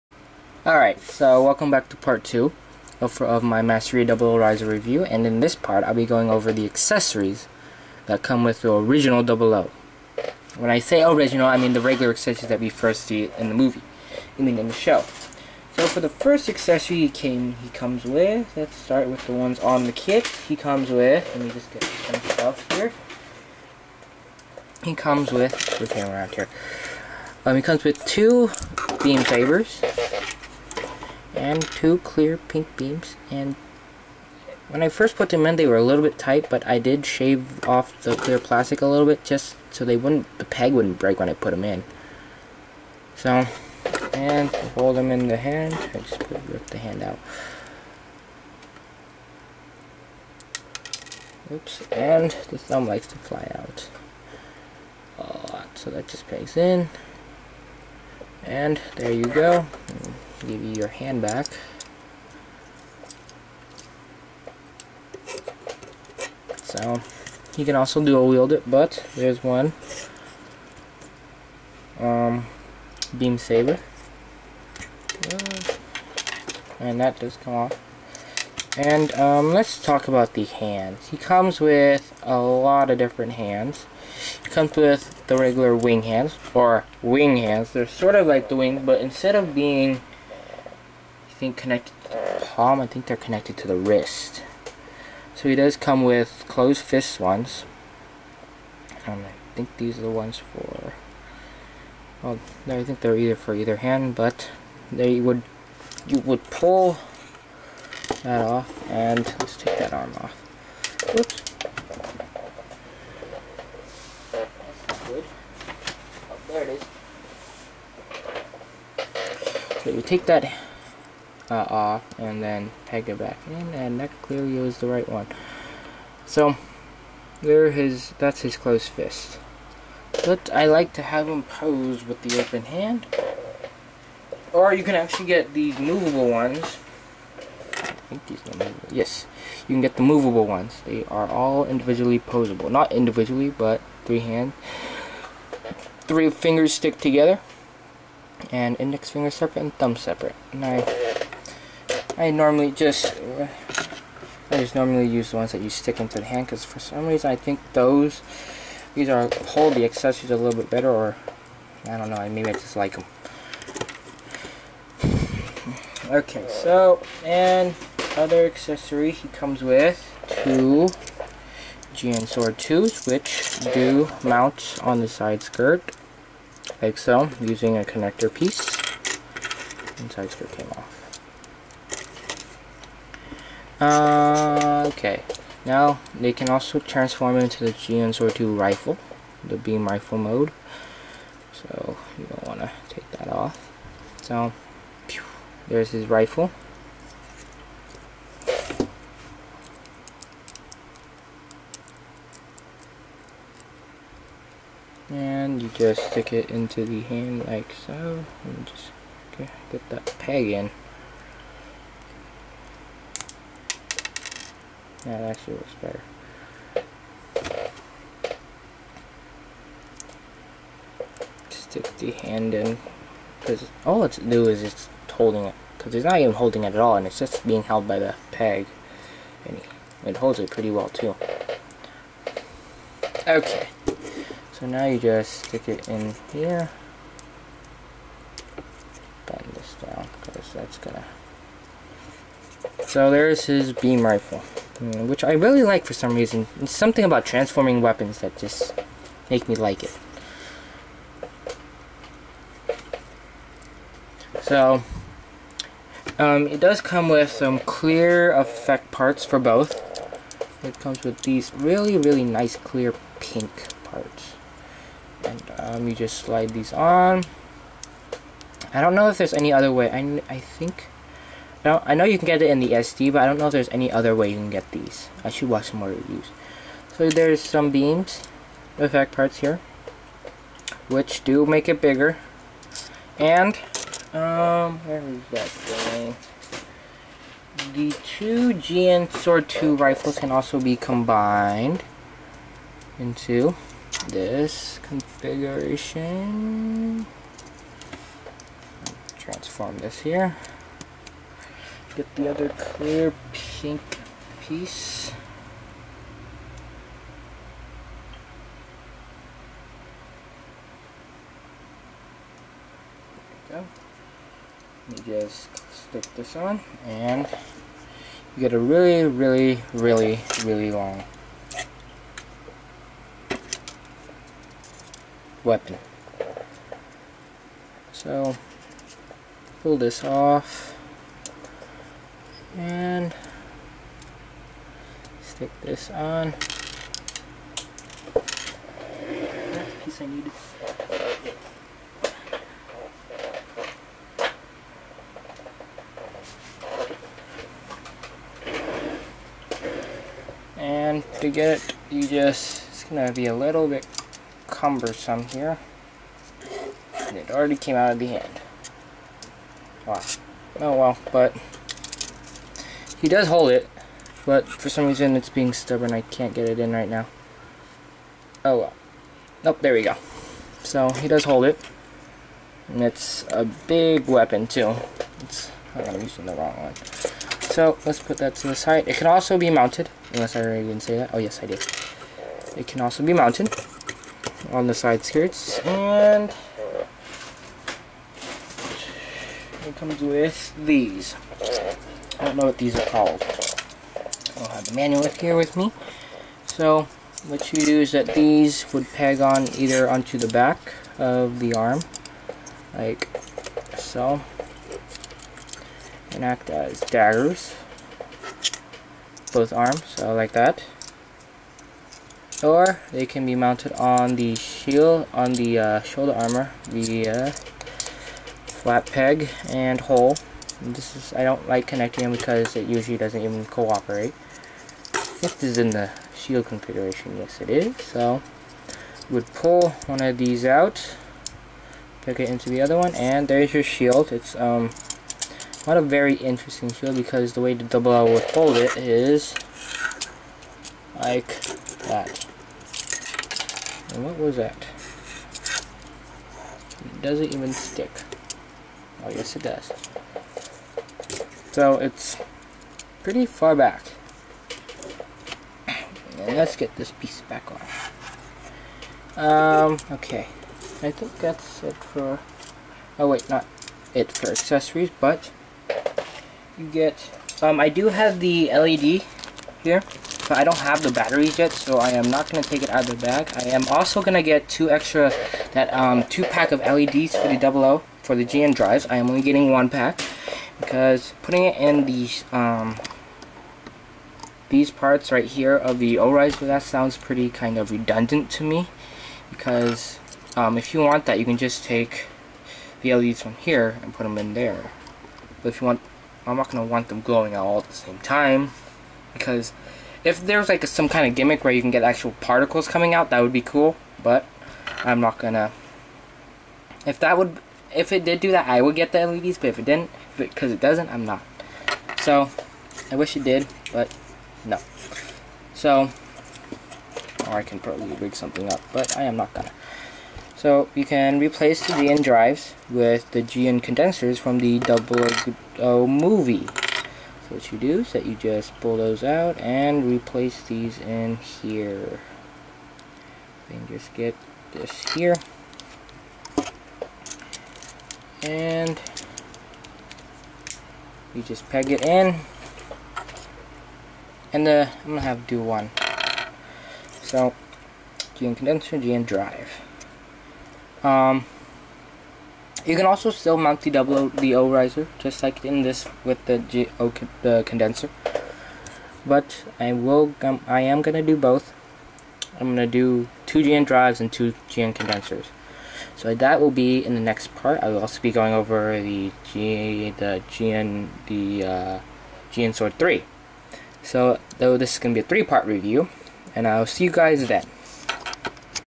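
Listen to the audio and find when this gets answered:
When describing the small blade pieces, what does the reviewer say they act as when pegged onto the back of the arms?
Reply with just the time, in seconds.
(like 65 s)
406 s.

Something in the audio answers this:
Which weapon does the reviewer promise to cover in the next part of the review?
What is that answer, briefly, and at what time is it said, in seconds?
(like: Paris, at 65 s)
GN Sword 3, at 572 s.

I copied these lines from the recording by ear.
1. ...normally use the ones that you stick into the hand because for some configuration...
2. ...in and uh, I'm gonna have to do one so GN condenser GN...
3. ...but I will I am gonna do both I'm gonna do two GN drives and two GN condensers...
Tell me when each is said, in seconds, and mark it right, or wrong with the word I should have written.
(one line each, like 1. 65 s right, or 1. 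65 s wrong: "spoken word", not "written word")
1. 154 s wrong: "reason", not "configuration"
2. 541 s right
3. 559 s right.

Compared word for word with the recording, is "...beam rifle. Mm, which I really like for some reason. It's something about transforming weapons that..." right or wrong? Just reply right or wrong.
right.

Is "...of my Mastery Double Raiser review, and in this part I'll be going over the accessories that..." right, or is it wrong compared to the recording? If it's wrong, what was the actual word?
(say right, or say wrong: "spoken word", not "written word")
right.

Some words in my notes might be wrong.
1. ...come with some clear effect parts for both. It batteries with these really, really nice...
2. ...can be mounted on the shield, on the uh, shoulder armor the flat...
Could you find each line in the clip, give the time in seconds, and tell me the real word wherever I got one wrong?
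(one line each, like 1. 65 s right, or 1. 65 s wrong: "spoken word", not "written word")
1. 256 s wrong: "comes", not "batteries"
2. 413 s right.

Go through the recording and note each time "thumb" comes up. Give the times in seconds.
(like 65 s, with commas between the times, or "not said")
52 s, 149 s.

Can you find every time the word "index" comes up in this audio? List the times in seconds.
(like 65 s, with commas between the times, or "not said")
148 s.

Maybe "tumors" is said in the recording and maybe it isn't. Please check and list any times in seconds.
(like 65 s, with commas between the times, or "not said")
not said.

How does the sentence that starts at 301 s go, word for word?
Get the other clear pink piece.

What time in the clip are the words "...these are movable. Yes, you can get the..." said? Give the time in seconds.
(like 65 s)
138 s.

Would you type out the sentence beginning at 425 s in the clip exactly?
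If this is in the shield configuration, yes it is.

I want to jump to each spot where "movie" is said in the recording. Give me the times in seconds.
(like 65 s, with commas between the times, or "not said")
13 s, 525 s.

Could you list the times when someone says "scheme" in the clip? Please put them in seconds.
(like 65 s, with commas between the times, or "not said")
not said.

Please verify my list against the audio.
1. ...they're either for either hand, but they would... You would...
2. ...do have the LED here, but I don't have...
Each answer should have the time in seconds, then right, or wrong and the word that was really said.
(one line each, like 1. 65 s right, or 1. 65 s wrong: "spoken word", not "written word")
1. 103 s right
2. 467 s right.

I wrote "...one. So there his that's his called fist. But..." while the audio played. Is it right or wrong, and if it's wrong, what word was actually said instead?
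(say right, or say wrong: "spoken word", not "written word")
wrong: "closed", not "called".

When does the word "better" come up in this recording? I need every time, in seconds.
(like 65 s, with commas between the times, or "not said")
160 s, 215 s.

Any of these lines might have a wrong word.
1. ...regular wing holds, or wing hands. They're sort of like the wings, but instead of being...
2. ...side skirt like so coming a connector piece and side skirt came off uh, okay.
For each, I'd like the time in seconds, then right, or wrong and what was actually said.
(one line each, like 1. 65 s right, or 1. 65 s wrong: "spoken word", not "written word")
1. 85 s wrong: "hands", not "holds"
2. 175 s wrong: "using", not "coming".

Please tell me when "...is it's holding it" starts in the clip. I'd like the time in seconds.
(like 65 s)
224 s.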